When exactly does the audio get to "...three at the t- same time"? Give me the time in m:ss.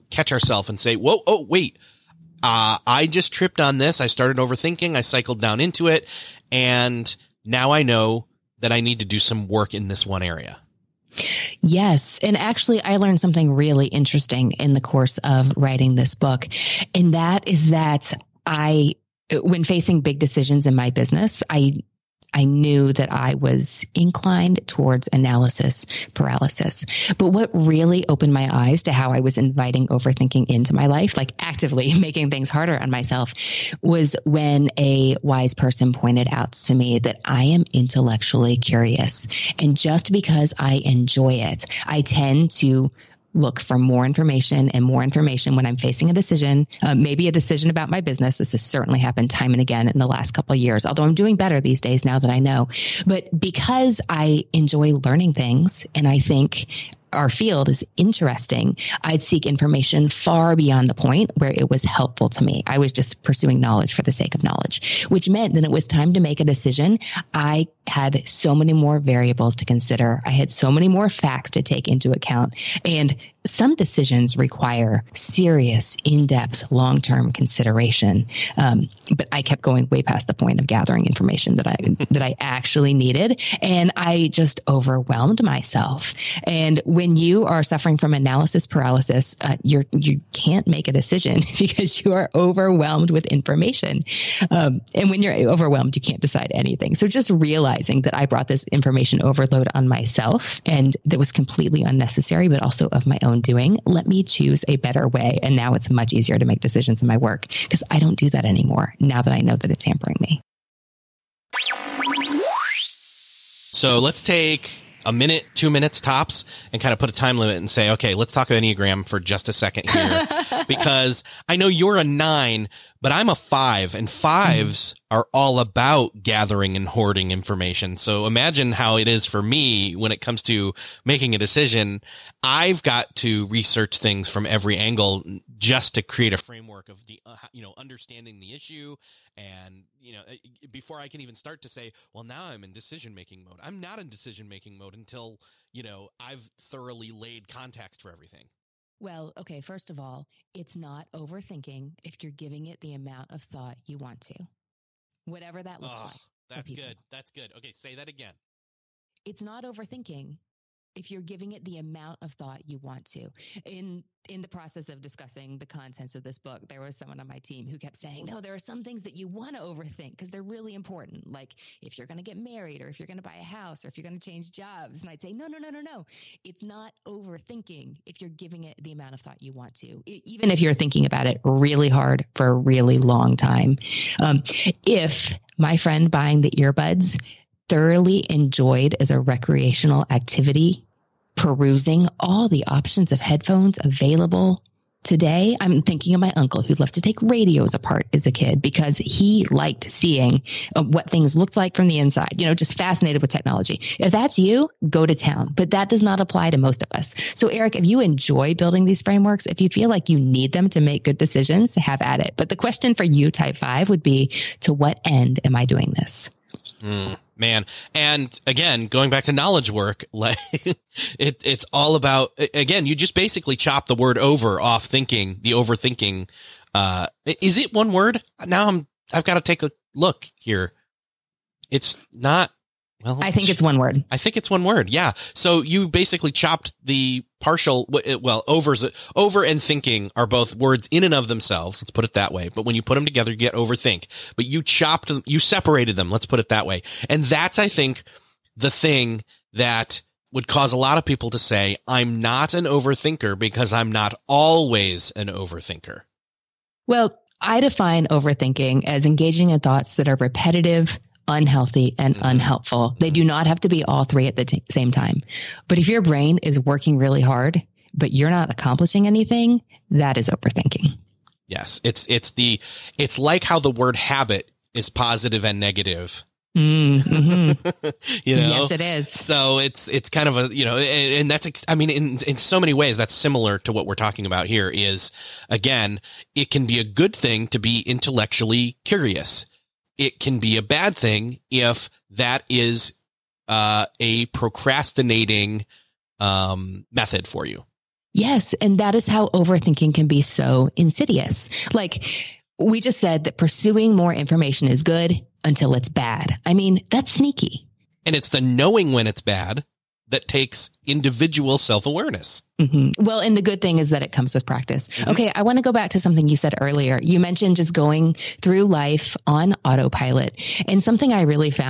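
4:24.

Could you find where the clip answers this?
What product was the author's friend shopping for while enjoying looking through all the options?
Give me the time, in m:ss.
3:06.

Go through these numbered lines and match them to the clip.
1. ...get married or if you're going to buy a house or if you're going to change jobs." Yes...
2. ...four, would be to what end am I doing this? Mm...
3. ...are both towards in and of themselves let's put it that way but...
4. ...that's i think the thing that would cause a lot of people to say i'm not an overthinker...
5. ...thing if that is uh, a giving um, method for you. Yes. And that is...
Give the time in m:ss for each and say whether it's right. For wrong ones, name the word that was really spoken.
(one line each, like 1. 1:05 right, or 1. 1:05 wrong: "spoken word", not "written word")
1. 2:52 wrong: "And", not "Yes"
2. 3:33 wrong: "five", not "four"
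3. 4:00 wrong: "words", not "towards"
4. 4:07 right
5. 4:50 wrong: "procrastinating", not "giving".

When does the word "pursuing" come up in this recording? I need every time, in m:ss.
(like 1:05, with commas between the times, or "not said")
1:03, 5:03.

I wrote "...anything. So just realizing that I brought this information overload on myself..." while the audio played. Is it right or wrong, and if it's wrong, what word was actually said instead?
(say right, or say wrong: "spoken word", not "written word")
right.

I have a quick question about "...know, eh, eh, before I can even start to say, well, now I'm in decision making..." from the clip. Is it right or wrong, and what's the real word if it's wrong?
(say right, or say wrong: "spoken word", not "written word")
right.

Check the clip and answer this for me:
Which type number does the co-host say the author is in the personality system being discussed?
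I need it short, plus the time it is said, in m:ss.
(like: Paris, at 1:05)
9, at 2:02.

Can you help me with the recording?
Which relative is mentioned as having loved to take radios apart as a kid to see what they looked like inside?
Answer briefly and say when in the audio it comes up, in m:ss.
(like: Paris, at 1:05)
Uncle, at 3:16.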